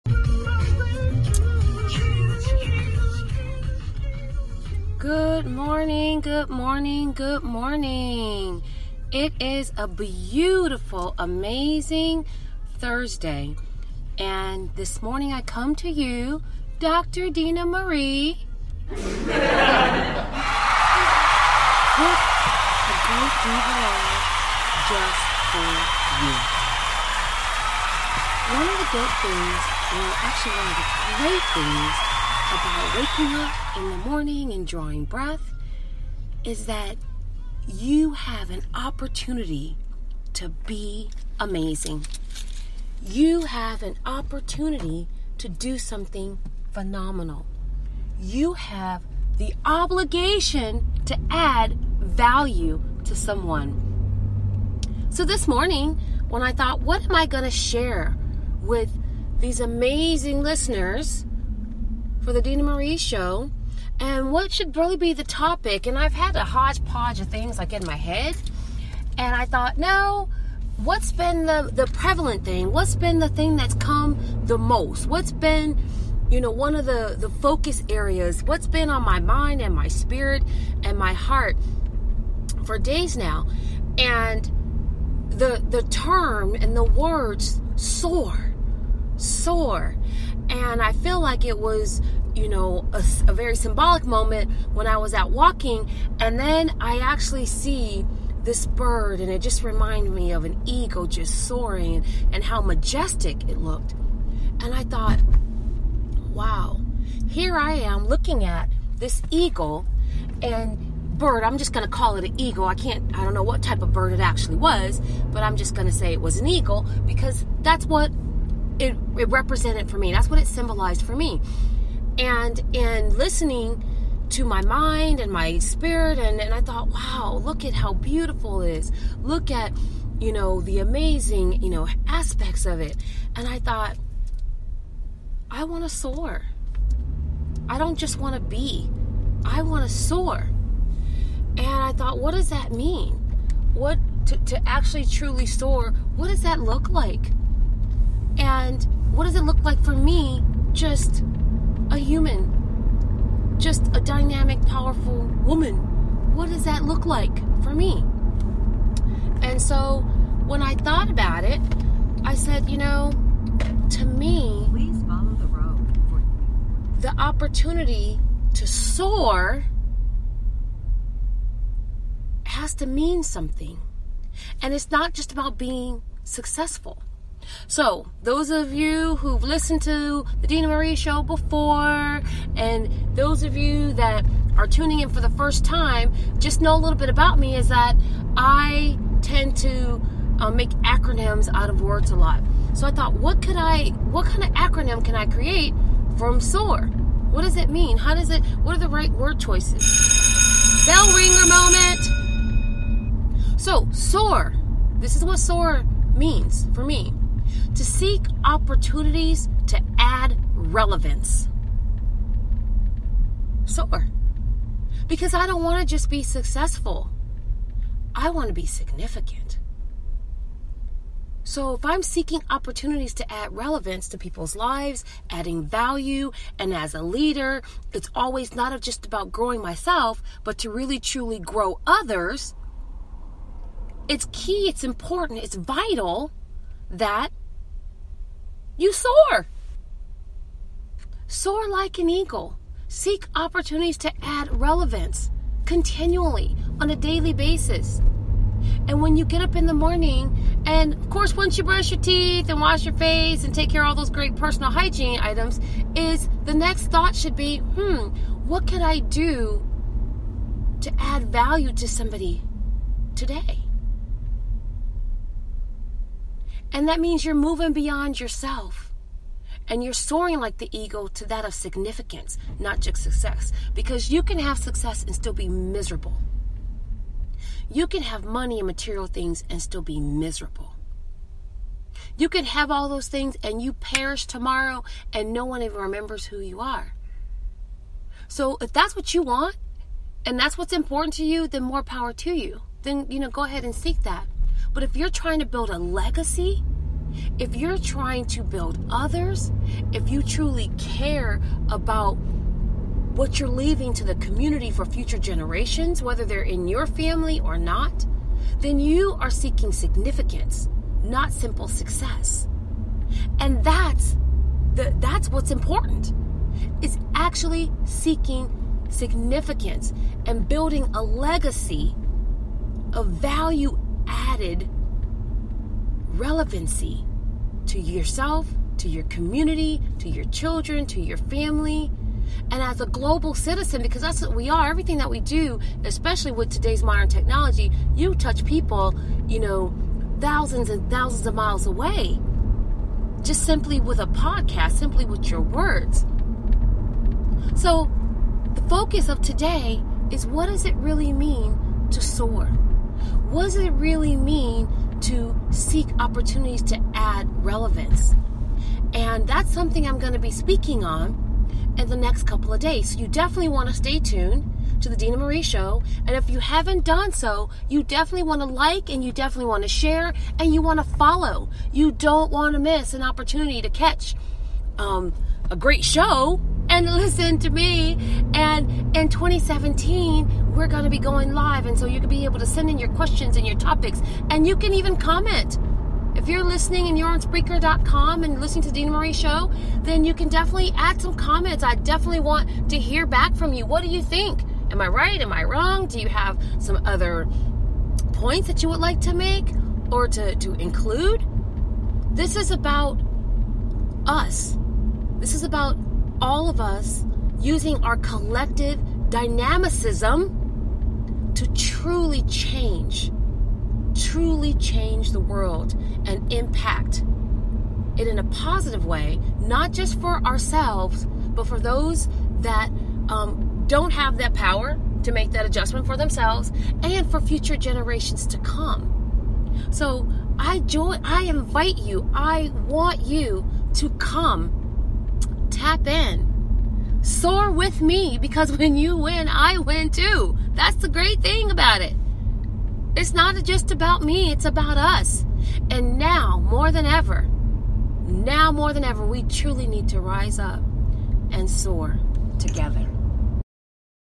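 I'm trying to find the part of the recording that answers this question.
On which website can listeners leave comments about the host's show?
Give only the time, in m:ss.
6:27.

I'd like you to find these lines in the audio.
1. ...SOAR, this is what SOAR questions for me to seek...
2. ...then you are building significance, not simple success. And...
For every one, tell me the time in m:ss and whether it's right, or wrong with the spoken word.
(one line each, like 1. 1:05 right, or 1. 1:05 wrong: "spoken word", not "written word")
1. 3:23 wrong: "means", not "questions"
2. 5:08 wrong: "seeking", not "building".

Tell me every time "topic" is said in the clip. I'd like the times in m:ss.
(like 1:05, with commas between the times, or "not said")
1:05, 6:23.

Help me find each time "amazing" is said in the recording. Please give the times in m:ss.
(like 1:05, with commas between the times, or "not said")
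0:11, 0:41, 0:59, 2:10.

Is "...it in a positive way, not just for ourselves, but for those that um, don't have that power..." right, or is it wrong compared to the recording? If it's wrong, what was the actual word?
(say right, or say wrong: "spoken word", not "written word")
right.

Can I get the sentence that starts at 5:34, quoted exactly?
Everything that we do, especially with today's modern technology, you touch people, you know, thousands and thousands of miles away.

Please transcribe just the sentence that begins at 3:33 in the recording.
so Because I don't want to just be successful, I want to be significant.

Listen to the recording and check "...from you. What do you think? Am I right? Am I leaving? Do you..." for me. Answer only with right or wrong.
wrong.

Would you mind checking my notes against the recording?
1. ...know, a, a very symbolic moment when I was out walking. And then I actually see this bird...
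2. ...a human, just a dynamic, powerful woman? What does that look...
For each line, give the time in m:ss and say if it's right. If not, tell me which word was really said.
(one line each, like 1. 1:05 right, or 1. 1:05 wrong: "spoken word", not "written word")
1. 1:32 right
2. 2:31 right.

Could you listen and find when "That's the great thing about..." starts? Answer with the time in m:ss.
7:20.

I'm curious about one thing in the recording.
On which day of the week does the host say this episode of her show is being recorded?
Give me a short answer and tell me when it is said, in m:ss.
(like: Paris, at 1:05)
Thursday, at 0:12.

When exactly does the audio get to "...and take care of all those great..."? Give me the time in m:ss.
4:13.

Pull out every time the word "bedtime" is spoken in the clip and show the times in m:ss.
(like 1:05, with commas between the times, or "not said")
not said.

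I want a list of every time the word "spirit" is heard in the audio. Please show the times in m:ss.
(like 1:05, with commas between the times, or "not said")
1:19, 2:05.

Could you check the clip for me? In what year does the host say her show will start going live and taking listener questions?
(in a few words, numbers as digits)
2017.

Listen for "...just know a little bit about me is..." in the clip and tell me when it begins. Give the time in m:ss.
3:06.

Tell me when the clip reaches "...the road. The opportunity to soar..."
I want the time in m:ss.
2:45.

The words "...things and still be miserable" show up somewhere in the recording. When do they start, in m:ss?
4:39.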